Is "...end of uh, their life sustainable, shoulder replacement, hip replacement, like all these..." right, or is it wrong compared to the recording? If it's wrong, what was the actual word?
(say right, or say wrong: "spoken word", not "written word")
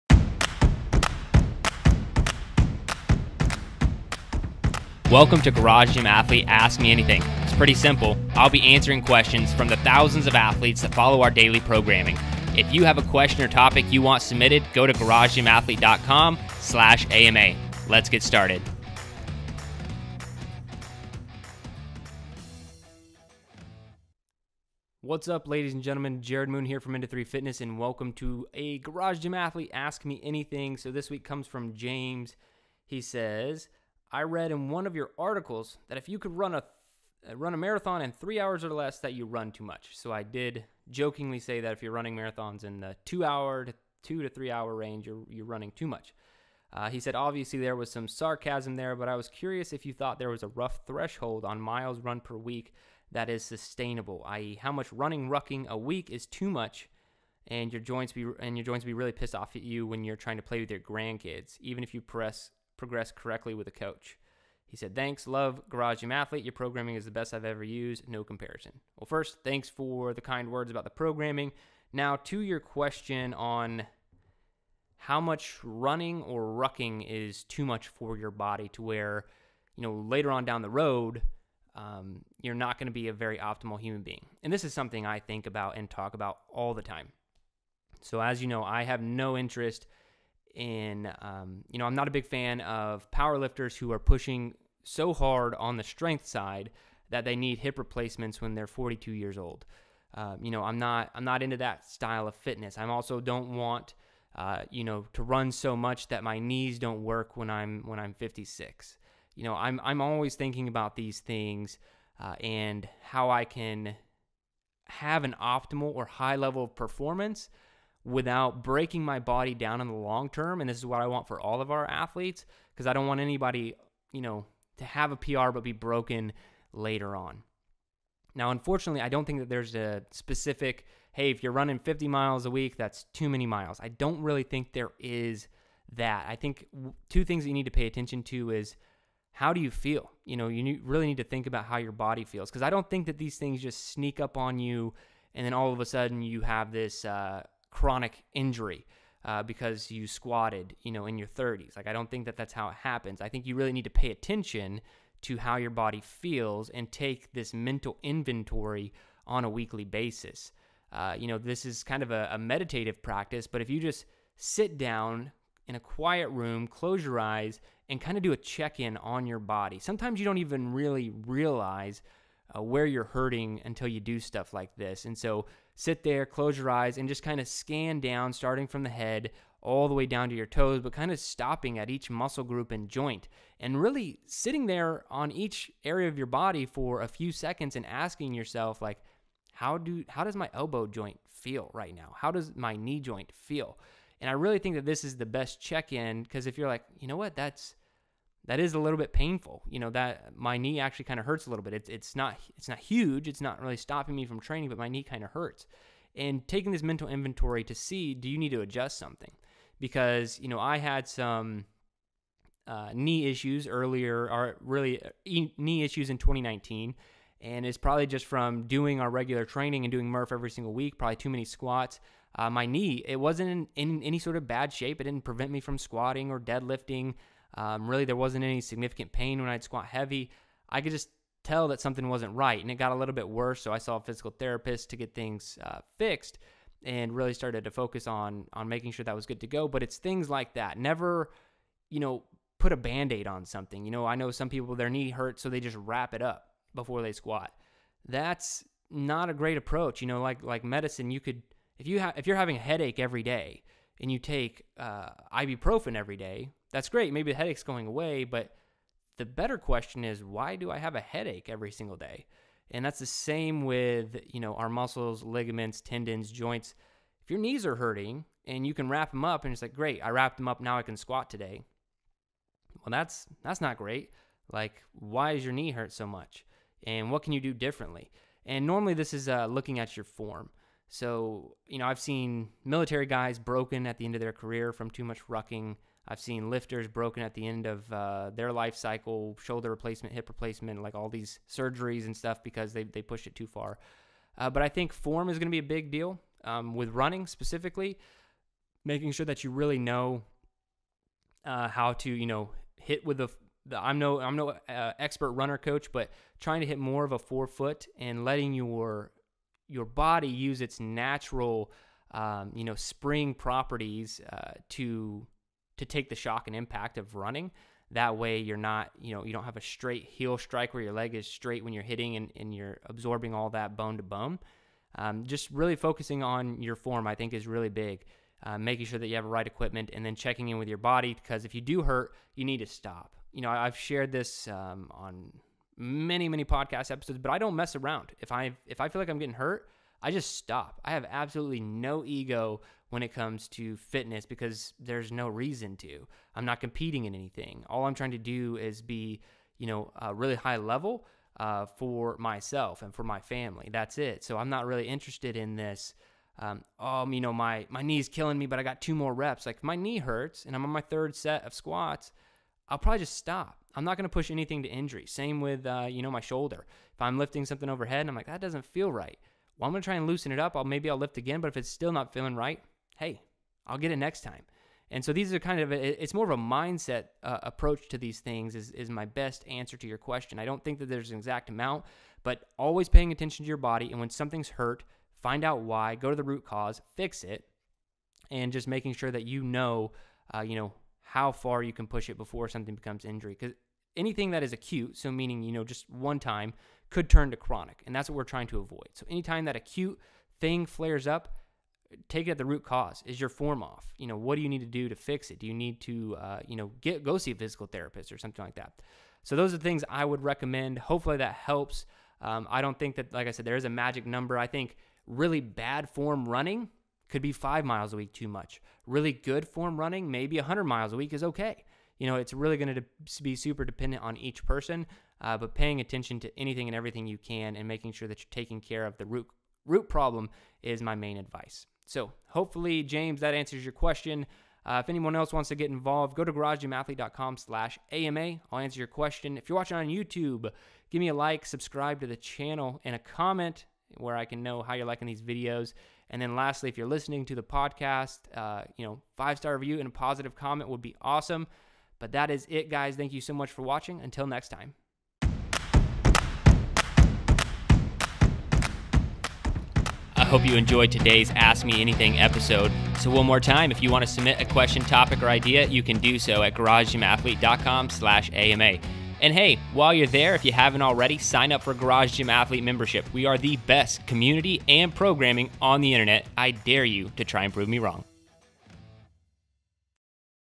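wrong: "cycle", not "sustainable".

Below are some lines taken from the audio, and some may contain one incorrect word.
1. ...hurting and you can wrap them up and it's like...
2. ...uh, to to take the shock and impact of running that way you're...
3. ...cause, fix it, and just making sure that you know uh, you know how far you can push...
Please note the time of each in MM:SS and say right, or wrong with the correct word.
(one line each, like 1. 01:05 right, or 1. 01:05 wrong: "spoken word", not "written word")
1. 04:27 right
2. 05:14 right
3. 06:26 right.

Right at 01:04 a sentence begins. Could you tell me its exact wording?
He said, Thanks, love Garage Gym Athlete.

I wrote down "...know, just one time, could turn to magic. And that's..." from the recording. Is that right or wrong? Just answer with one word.
wrong.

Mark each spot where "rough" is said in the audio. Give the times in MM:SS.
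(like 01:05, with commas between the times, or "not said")
00:50.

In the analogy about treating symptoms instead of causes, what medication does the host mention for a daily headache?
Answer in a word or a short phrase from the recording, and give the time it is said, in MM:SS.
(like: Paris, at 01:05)
ibuprofen, at 04:15.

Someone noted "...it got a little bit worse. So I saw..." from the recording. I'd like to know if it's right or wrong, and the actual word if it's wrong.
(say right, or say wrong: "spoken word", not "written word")
right.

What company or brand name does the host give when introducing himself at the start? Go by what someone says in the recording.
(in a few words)
End of Three Fitness.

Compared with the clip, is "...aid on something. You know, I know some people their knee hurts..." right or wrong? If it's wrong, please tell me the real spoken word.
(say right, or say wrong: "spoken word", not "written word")
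right.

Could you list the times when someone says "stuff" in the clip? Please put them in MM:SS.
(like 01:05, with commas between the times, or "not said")
02:54, 04:52.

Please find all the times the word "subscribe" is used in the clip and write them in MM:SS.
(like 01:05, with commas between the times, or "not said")
07:21.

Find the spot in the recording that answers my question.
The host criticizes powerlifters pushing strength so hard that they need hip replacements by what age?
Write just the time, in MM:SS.
01:38.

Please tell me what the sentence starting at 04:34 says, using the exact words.
Like, why is your knee hurt so much?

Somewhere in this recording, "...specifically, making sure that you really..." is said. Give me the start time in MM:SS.
04:57.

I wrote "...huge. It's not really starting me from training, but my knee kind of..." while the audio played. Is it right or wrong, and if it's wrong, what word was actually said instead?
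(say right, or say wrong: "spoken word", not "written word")
wrong: "stopping", not "starting".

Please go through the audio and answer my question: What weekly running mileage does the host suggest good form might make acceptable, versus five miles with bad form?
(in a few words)
100 miles.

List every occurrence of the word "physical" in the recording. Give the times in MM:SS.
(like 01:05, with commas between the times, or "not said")
03:54, 06:47.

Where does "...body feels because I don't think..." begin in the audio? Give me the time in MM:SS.
02:21.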